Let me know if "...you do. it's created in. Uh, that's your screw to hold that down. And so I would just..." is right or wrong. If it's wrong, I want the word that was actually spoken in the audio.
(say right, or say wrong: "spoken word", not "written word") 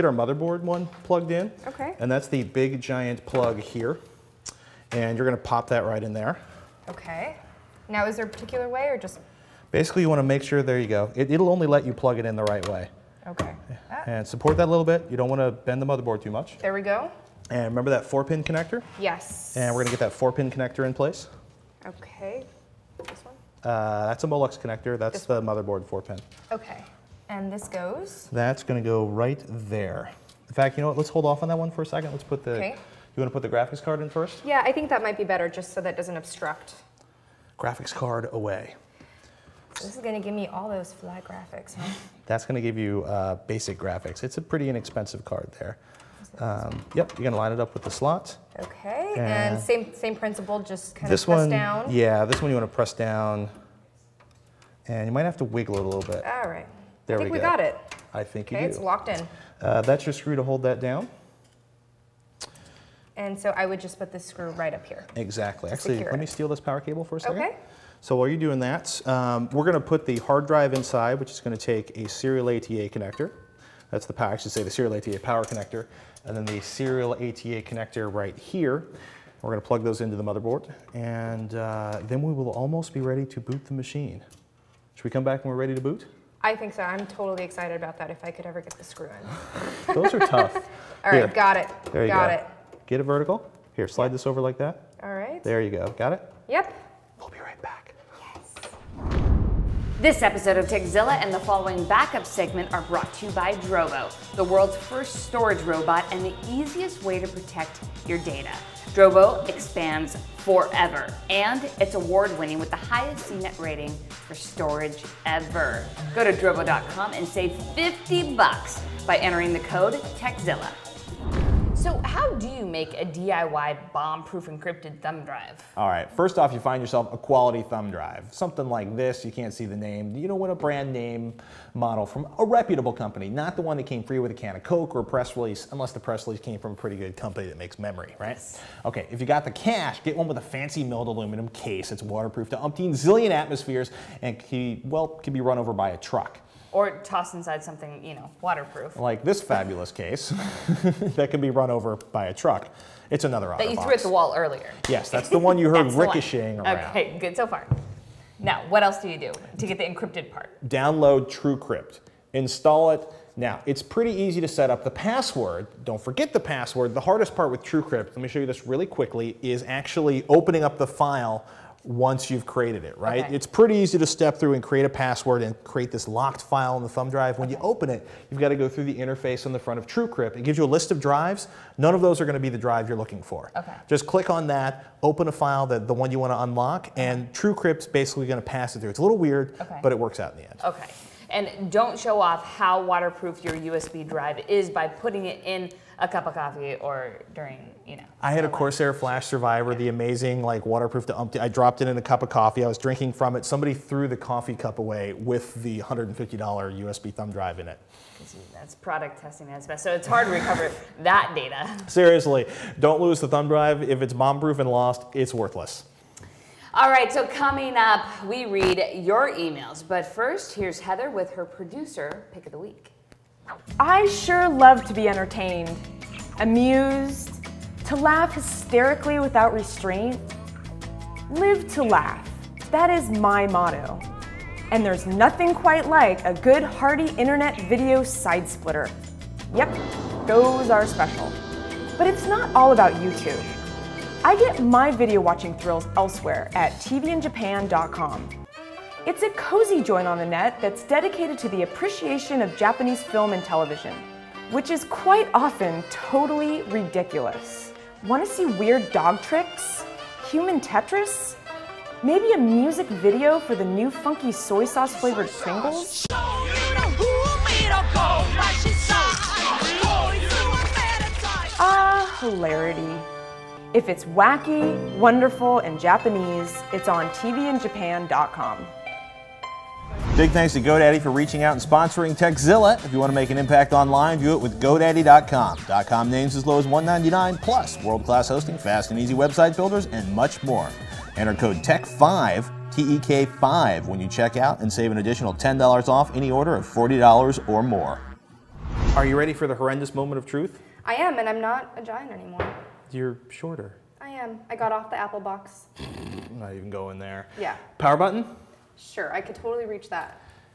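wrong: "locked", not "created".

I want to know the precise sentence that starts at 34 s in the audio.
Yeah, I think that might be better just so that doesn't obstruct.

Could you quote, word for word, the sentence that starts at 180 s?
It gives you a list of drives.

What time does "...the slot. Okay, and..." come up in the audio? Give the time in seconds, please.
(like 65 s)
47 s.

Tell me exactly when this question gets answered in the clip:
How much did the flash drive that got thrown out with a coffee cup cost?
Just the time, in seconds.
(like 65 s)
205 s.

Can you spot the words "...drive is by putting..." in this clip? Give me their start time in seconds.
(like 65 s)
194 s.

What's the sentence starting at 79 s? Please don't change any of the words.
We're gonna plug those into the motherboard.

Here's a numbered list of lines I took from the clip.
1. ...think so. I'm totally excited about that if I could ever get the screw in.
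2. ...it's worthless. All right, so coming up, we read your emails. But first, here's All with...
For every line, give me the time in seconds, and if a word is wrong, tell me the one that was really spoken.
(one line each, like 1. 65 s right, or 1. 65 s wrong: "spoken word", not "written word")
1. 86 s right
2. 215 s wrong: "Heather", not "All".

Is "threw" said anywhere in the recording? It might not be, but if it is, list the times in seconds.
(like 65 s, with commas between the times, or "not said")
153 s, 203 s.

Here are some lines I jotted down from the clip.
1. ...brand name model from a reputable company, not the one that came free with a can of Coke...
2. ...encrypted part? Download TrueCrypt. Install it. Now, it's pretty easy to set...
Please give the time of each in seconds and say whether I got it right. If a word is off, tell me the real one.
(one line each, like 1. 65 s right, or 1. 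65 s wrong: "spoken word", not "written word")
1. 130 s right
2. 159 s right.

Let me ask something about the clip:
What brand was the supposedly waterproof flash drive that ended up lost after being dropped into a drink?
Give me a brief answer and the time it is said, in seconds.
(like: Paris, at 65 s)
Corsair, at 198 s.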